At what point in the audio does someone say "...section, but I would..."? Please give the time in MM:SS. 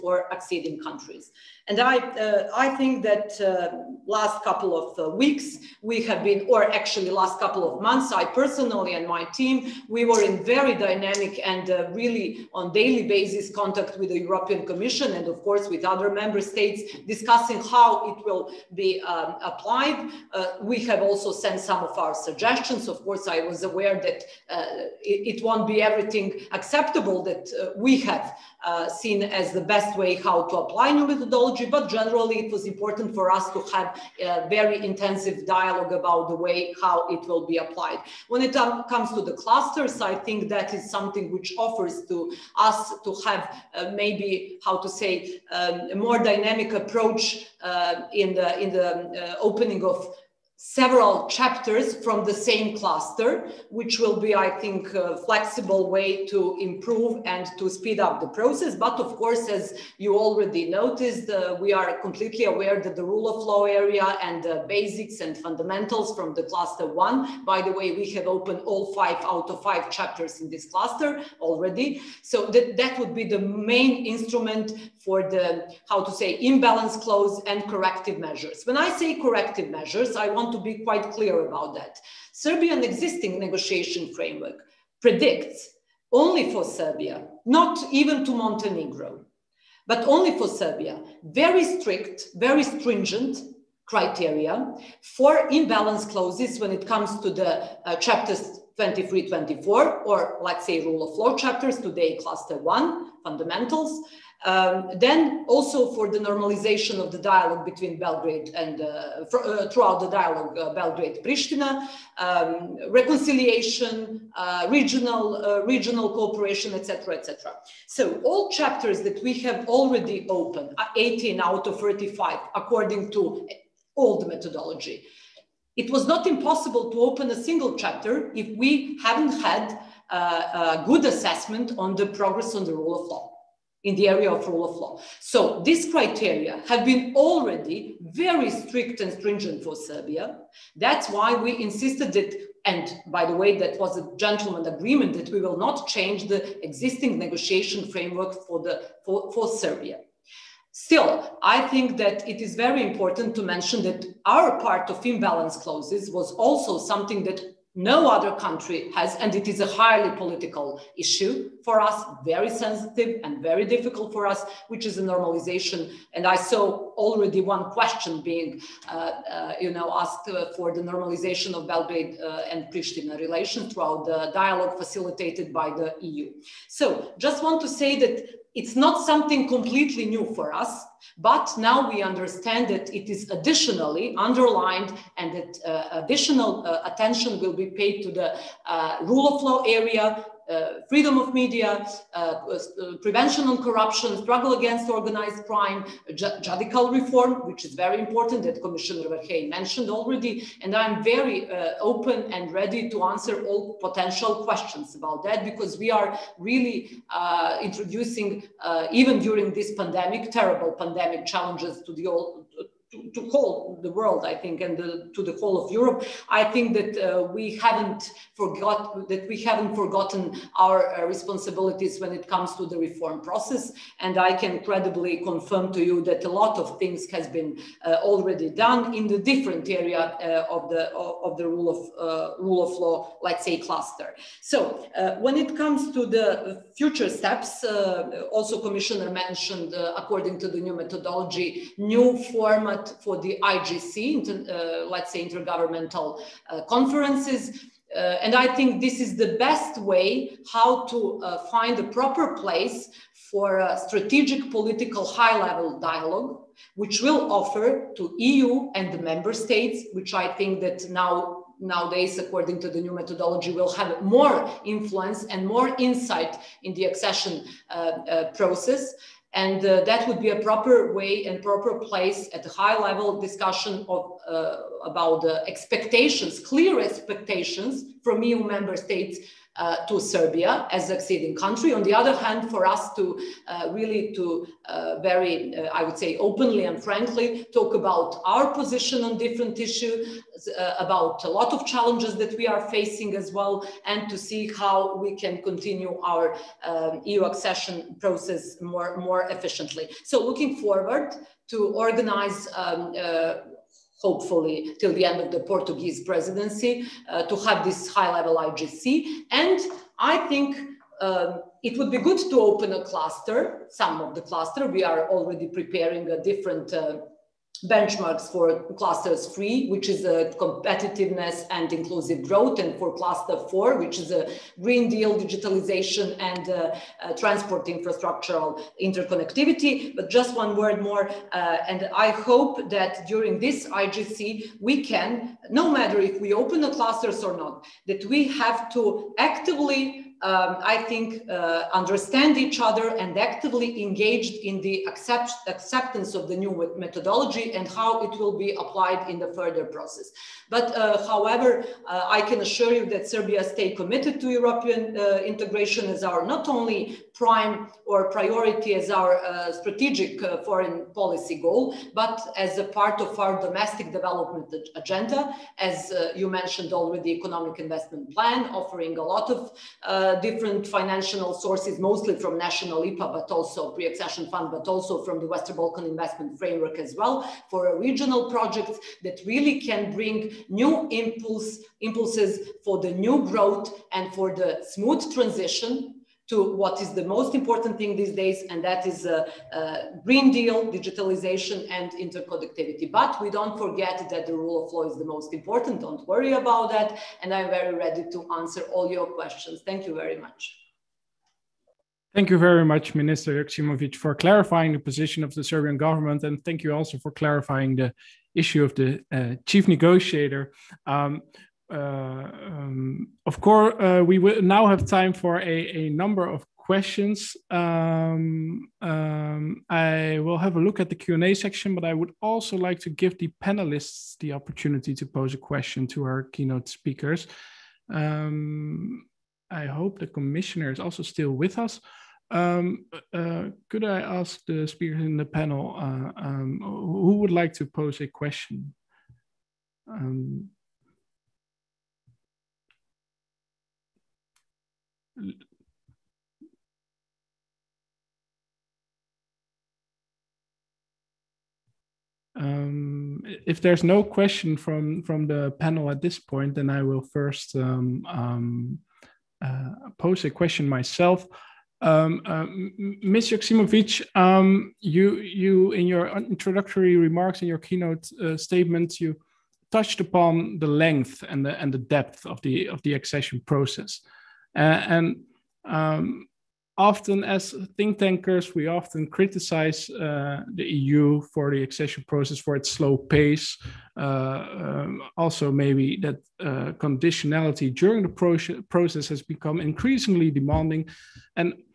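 07:01.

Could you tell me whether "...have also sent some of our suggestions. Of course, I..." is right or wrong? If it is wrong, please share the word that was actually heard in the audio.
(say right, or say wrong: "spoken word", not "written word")
right.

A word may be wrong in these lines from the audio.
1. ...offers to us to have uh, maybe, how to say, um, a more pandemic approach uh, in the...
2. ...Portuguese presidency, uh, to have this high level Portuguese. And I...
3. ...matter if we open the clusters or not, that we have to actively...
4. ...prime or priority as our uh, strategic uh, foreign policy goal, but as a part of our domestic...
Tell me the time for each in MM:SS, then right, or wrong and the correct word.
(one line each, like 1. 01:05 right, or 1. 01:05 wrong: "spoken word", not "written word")
1. 00:41 wrong: "dynamic", not "pandemic"
2. 05:05 wrong: "IGC", not "Portuguese"
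3. 05:35 right
4. 05:57 right.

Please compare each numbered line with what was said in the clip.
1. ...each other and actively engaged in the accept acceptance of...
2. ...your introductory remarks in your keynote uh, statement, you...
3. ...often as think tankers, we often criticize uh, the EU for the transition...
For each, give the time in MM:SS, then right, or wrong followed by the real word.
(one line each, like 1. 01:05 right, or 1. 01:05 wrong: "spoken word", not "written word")
1. 05:42 right
2. 07:45 right
3. 07:56 wrong: "accession", not "transition".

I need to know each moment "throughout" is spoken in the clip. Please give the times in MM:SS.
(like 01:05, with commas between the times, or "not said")
01:49, 02:53.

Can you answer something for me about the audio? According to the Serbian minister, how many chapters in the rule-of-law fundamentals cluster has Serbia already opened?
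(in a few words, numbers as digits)
5.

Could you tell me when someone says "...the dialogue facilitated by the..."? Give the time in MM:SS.
02:54.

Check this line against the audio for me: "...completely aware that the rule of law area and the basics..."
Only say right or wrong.
right.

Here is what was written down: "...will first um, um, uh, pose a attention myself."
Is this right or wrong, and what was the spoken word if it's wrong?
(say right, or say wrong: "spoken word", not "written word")
wrong: "question", not "attention".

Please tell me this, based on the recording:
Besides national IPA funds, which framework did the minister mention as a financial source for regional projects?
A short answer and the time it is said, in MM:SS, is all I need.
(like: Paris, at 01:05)
Western Balkan Investment Framework, at 06:15.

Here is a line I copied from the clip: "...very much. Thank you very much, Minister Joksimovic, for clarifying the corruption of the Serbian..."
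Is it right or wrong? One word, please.
wrong.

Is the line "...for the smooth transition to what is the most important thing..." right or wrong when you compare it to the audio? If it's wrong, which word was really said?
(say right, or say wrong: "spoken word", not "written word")
right.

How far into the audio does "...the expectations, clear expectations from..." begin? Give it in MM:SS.
04:35.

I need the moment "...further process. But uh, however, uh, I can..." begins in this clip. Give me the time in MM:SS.
05:49.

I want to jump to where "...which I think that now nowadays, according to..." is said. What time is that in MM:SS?
04:19.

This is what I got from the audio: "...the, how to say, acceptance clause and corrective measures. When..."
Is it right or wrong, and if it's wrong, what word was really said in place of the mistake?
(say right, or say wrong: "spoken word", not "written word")
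wrong: "imbalance", not "acceptance".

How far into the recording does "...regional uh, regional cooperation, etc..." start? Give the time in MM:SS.
01:54.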